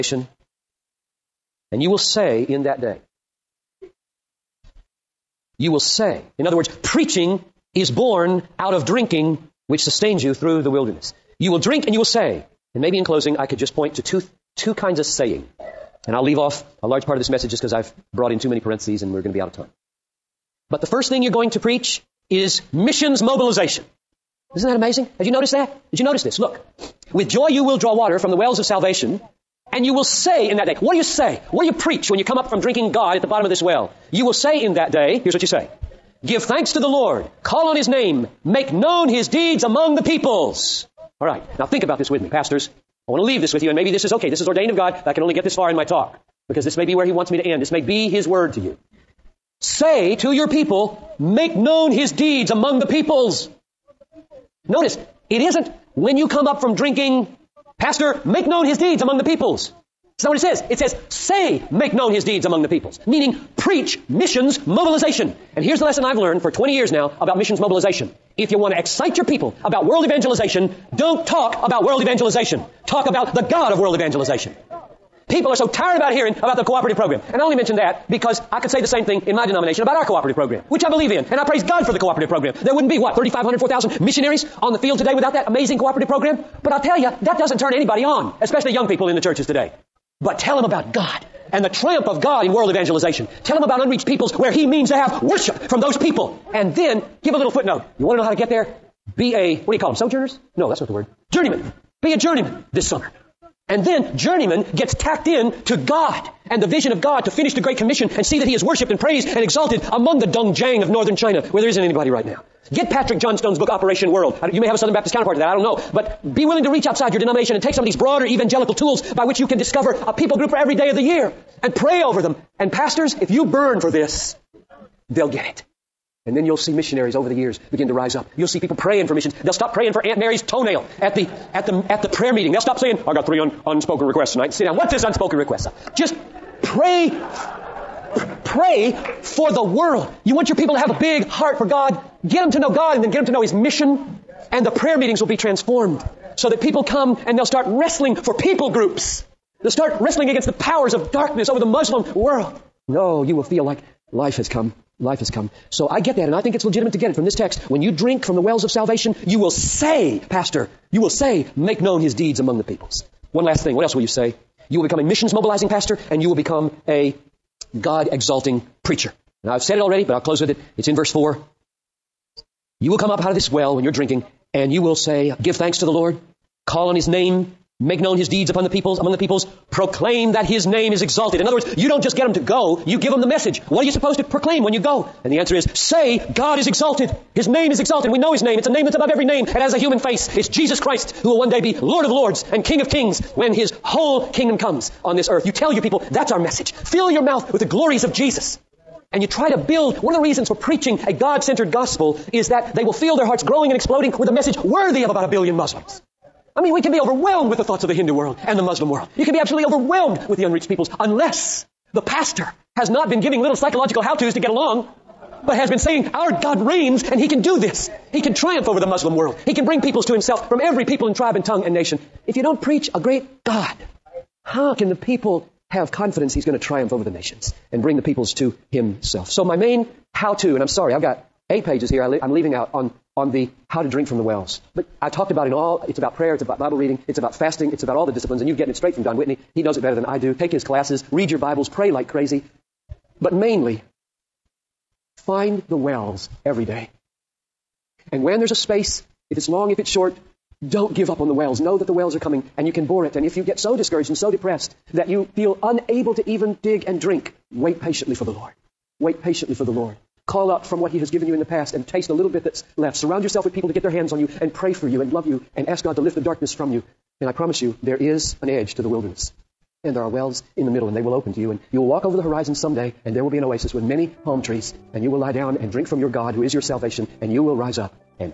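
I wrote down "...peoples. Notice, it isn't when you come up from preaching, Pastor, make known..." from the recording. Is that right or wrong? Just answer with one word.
wrong.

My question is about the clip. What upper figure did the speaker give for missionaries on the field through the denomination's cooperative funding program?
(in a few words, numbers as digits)
4,000.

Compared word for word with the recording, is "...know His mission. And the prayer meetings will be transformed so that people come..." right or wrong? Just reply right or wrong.
right.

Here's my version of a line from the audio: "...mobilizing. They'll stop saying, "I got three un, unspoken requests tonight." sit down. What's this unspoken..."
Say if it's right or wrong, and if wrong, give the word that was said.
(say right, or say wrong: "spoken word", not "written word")
wrong: "meeting", not "mobilizing".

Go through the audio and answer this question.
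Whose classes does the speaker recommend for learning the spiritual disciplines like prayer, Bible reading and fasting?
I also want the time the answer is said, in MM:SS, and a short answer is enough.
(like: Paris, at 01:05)
Don Whitney, at 03:59.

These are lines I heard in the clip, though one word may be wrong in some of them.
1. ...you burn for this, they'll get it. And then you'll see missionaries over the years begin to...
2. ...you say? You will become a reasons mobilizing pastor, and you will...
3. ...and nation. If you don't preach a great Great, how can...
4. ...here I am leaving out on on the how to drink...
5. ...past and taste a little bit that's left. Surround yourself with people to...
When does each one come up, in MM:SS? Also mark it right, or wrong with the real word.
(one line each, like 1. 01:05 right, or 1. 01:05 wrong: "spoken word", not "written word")
1. 02:03 right
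2. 02:44 wrong: "missions", not "reasons"
3. 03:41 wrong: "God", not "Great"
4. 03:51 right
5. 04:21 right.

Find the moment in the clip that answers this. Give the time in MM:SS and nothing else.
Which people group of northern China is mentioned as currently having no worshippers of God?
01:50.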